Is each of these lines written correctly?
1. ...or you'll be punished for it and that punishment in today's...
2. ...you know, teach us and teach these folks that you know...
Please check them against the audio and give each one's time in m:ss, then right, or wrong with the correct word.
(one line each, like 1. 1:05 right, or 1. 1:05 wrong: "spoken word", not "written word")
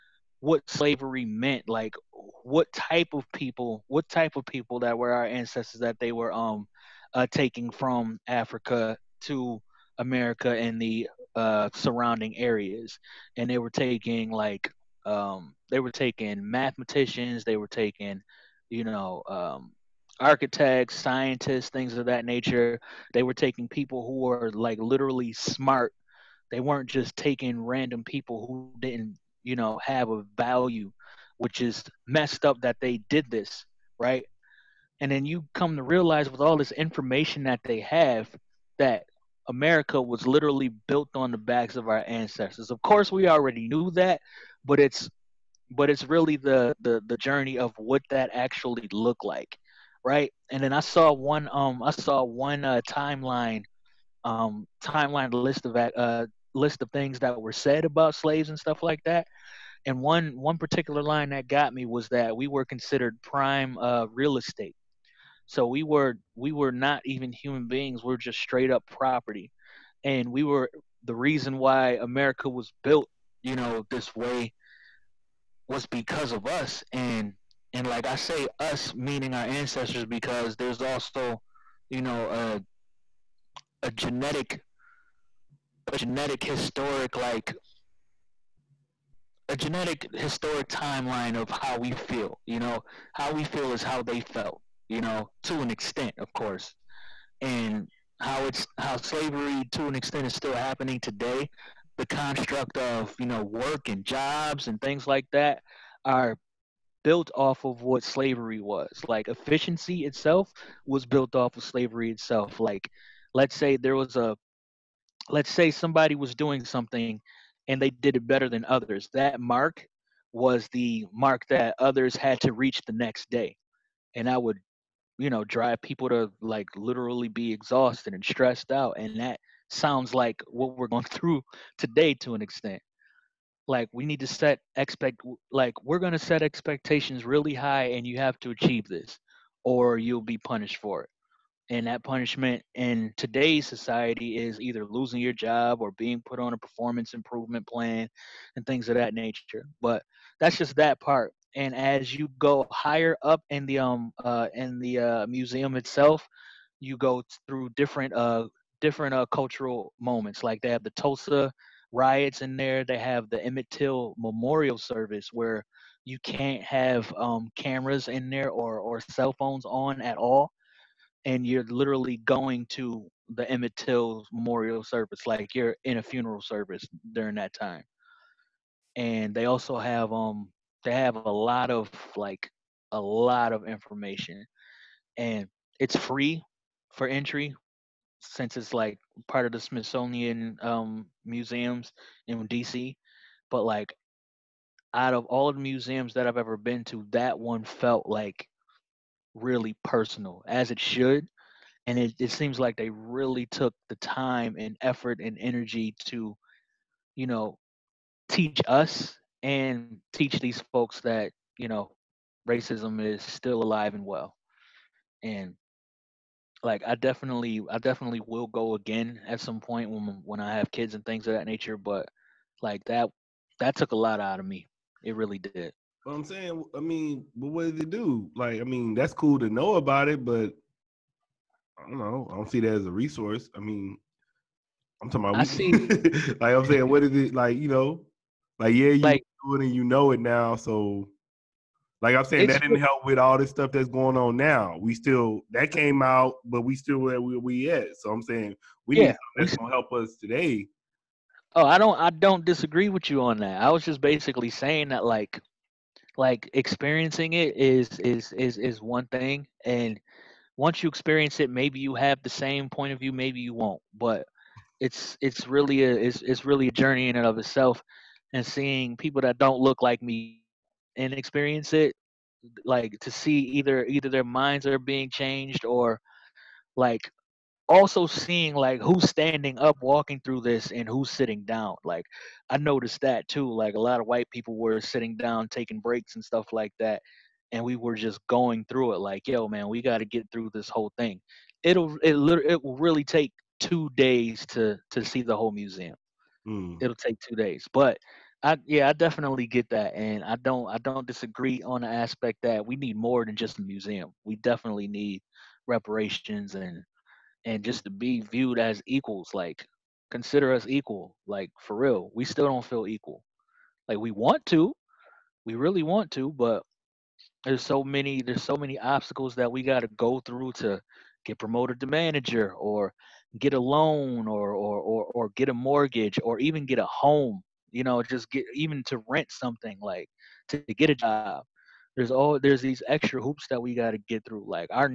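1. 2:19 right
2. 3:27 right.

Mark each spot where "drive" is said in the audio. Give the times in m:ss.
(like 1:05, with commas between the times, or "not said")
2:05.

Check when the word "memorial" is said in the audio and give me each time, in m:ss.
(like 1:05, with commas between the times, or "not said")
2:44, 2:54.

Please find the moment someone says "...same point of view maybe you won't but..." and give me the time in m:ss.
4:22.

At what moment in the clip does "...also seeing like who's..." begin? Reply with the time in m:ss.
4:37.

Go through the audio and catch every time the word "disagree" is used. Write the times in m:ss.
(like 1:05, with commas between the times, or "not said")
4:12, 5:01.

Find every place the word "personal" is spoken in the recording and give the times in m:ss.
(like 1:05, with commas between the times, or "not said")
3:19.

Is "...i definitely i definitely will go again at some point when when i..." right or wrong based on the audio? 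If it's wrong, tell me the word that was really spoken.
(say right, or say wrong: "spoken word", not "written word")
right.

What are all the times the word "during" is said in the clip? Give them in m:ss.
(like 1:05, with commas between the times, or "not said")
2:57.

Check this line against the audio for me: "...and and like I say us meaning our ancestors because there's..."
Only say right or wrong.
right.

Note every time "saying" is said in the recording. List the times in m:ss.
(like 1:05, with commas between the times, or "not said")
3:46, 3:56, 4:02, 4:08, 4:14.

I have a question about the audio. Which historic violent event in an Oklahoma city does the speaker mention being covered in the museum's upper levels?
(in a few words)
Tulsa riots.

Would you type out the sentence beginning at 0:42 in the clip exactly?
Of course, we already knew that, but it's but it's really the the the journey of what that actually looked like, right?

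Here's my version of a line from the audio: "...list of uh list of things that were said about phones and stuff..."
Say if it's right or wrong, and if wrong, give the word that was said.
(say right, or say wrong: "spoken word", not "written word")
wrong: "slaves", not "phones".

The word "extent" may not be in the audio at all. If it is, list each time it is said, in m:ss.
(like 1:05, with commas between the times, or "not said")
1:35, 1:39, 2:12.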